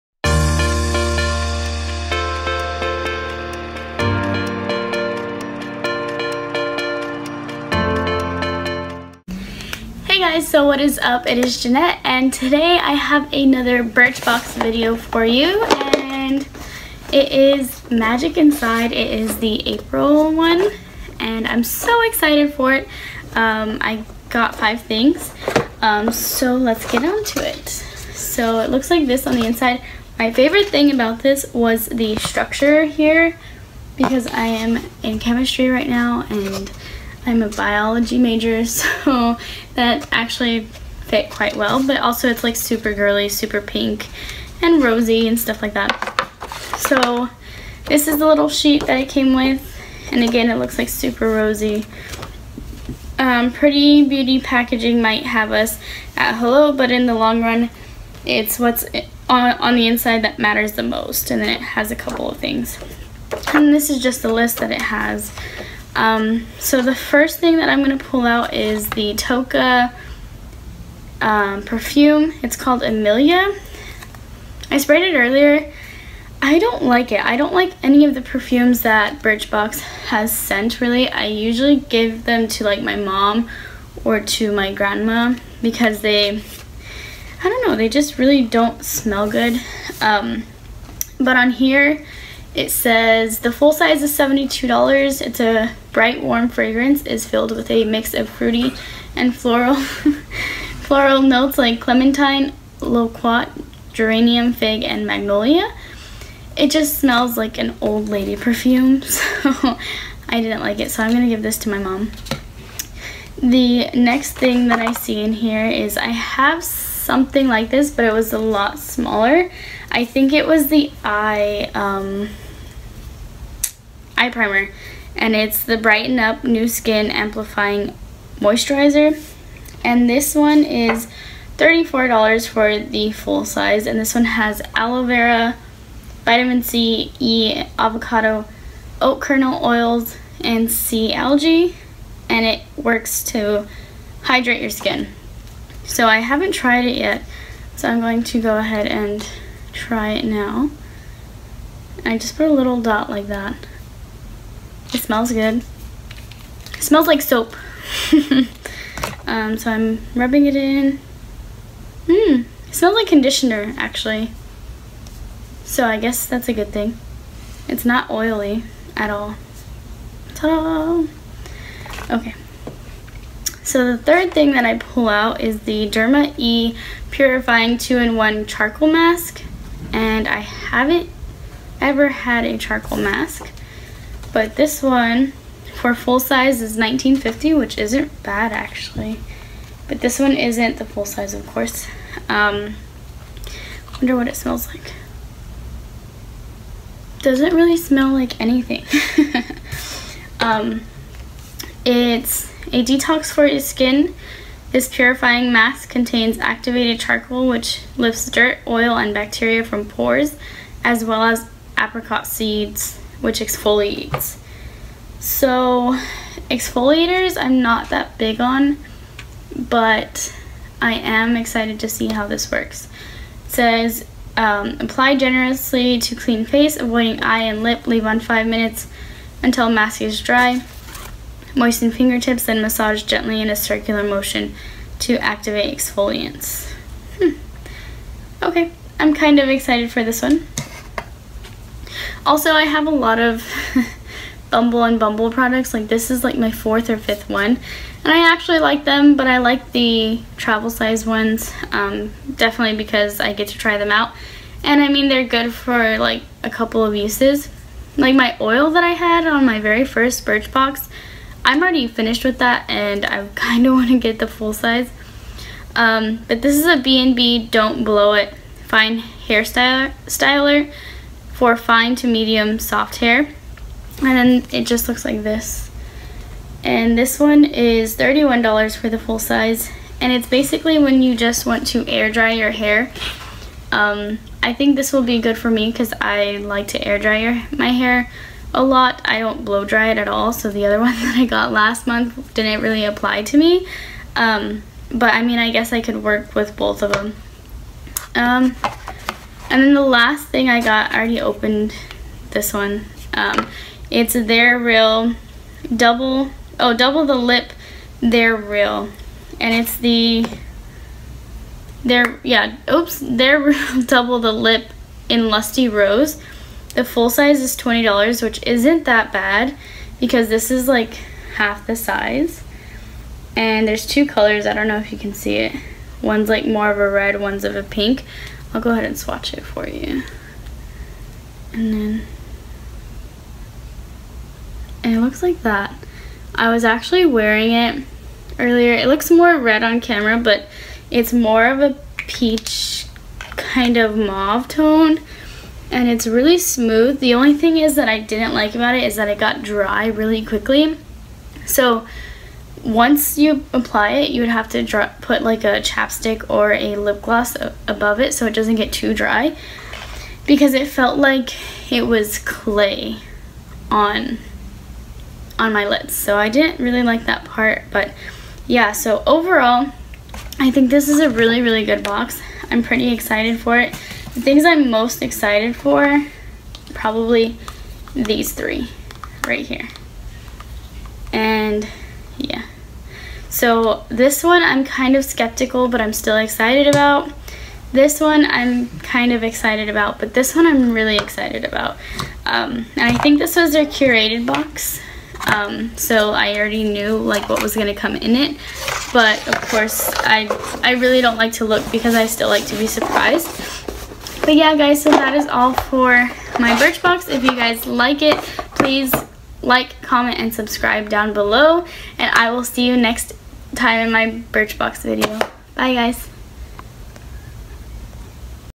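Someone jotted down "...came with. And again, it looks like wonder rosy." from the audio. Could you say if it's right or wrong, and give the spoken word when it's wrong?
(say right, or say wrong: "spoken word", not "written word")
wrong: "super", not "wonder".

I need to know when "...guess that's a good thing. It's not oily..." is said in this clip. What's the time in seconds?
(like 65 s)
165 s.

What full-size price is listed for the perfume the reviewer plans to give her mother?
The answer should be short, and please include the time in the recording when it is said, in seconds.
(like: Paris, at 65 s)
$72, at 94 s.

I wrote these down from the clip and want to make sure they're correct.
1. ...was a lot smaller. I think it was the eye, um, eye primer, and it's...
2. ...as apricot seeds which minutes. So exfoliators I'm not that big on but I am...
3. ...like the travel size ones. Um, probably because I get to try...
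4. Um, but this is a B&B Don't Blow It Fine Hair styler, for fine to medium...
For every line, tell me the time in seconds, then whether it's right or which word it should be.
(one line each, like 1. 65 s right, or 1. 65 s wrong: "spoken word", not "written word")
1. 118 s right
2. 211 s wrong: "exfoliates", not "minutes"
3. 249 s wrong: "definitely", not "probably"
4. 265 s right.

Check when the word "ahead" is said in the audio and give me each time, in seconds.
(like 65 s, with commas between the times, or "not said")
148 s, 328 s.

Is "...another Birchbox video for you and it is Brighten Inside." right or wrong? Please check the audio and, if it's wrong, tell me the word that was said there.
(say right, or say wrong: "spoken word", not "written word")
wrong: "Magic", not "Brighten".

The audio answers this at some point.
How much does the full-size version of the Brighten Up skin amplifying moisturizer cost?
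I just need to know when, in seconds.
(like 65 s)
131 s.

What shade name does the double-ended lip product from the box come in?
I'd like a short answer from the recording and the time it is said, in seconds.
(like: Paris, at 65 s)
Lusty Rose, at 315 s.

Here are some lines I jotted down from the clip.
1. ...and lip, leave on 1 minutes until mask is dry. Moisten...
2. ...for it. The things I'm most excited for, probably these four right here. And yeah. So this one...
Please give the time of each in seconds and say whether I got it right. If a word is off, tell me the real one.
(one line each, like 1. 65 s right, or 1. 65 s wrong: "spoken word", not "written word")
1. 227 s wrong: "5", not "1"
2. 373 s wrong: "three", not "four".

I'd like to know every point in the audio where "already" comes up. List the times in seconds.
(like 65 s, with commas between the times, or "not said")
261 s, 300 s, 396 s.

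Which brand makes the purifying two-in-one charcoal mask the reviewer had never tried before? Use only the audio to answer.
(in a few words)
Derma E.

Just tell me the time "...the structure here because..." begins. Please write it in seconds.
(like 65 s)
31 s.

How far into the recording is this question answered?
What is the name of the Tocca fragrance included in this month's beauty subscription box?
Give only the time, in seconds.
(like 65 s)
72 s.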